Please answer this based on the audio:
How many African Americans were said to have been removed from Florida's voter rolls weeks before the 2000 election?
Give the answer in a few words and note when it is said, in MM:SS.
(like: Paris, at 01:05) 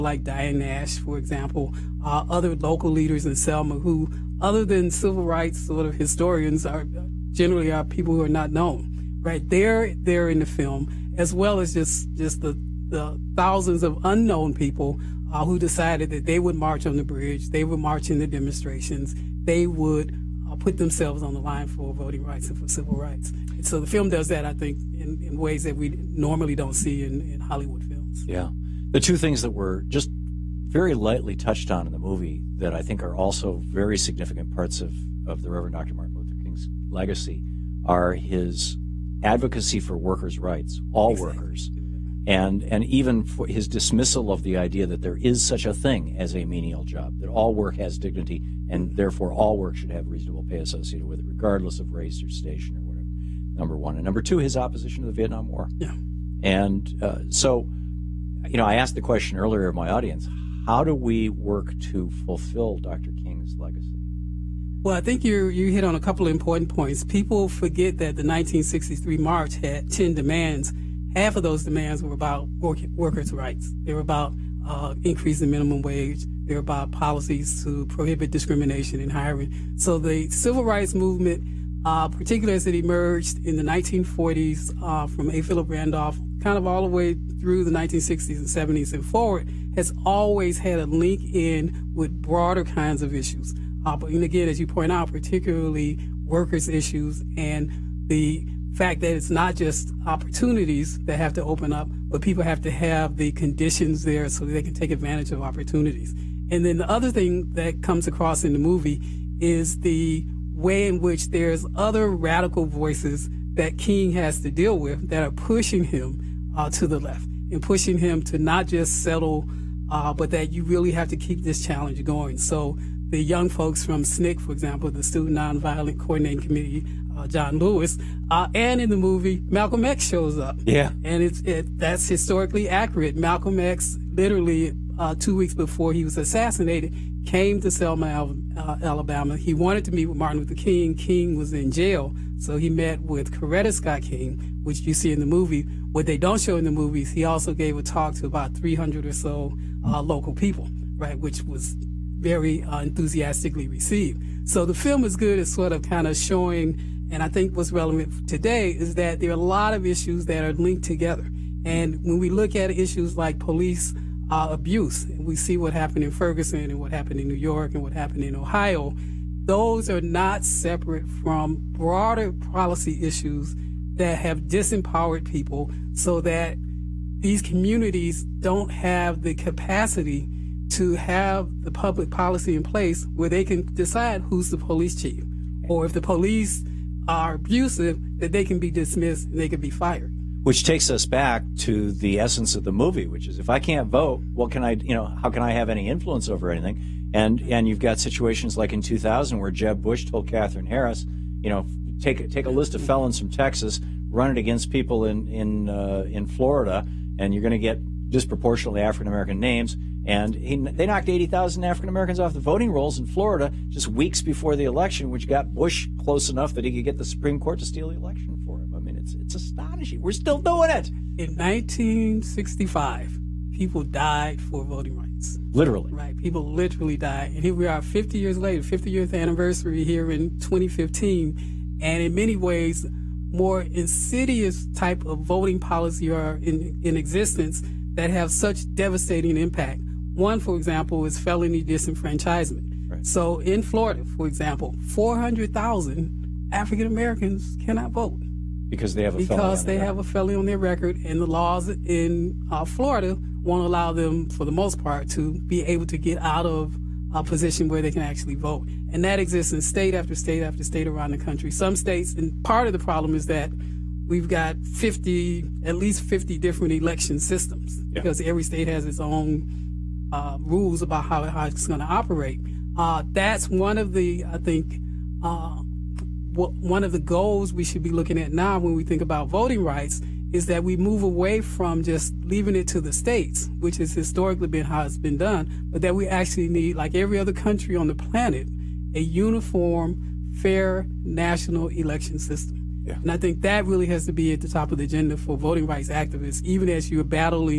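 80,000, at 03:31.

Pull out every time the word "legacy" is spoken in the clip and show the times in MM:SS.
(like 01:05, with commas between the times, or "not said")
00:36, 01:03.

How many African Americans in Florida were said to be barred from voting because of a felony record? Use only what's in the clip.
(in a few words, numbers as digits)
400,000.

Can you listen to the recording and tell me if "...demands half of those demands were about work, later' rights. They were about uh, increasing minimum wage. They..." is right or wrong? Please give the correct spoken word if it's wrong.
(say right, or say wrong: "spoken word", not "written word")
wrong: "workers", not "later".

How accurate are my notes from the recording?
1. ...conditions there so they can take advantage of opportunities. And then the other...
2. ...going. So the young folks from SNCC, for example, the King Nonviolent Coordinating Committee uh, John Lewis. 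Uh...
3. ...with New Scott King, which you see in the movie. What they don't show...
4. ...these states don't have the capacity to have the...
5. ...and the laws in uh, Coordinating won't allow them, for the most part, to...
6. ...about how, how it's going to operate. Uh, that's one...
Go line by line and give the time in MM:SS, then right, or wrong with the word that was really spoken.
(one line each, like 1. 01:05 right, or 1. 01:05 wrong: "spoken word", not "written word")
1. 01:43 right
2. 02:02 wrong: "Student", not "King"
3. 02:23 wrong: "Coretta", not "New"
4. 02:57 wrong: "communities", not "states"
5. 04:11 wrong: "Florida", not "Coordinating"
6. 04:30 right.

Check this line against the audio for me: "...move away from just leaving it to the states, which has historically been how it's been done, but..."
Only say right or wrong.
right.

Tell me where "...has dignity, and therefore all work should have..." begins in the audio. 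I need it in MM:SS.
00:47.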